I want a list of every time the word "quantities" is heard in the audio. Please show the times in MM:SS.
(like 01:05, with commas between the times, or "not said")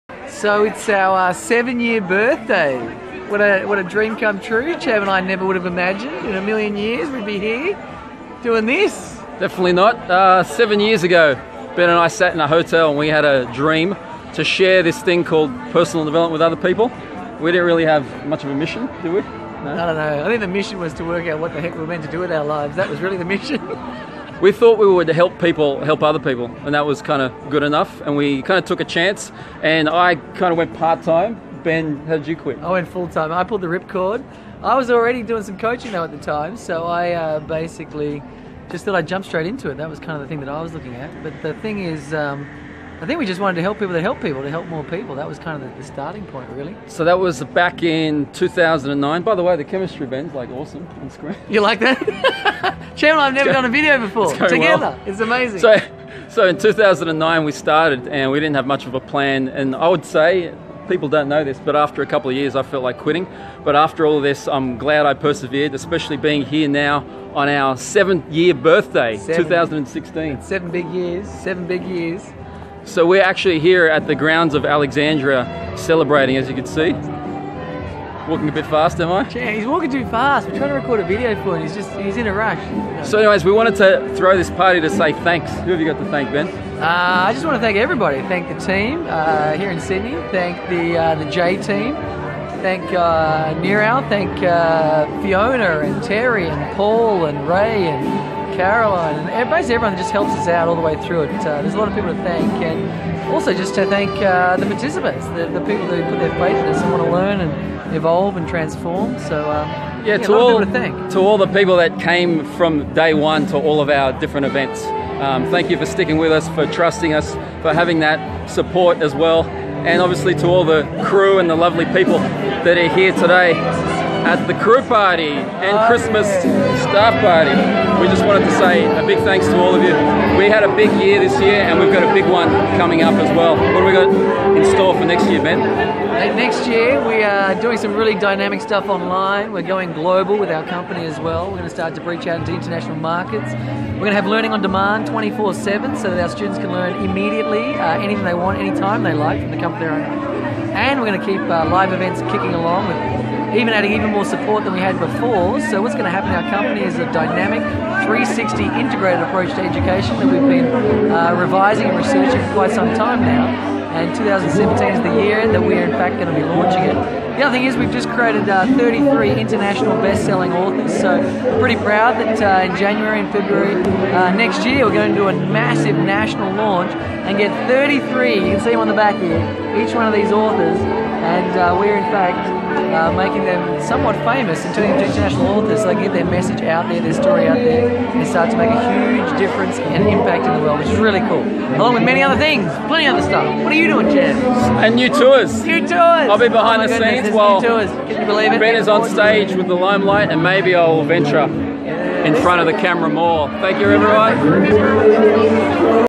not said.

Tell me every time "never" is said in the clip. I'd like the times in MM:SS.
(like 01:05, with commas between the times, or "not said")
00:05, 00:53.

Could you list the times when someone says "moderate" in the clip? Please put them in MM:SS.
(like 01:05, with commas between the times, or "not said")
not said.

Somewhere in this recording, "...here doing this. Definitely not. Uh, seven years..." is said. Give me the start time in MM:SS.
00:07.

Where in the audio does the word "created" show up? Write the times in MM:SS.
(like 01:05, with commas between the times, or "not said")
02:48.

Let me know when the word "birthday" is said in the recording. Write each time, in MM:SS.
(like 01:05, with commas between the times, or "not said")
00:02, 01:08.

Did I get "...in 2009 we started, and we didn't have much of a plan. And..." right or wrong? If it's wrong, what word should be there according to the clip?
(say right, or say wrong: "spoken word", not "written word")
right.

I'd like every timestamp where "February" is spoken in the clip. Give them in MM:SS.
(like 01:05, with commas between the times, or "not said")
02:53.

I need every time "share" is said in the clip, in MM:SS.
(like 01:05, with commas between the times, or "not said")
00:14.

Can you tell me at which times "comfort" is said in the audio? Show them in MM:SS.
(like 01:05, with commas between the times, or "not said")
02:29.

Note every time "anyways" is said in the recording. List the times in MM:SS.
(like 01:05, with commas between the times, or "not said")
01:23.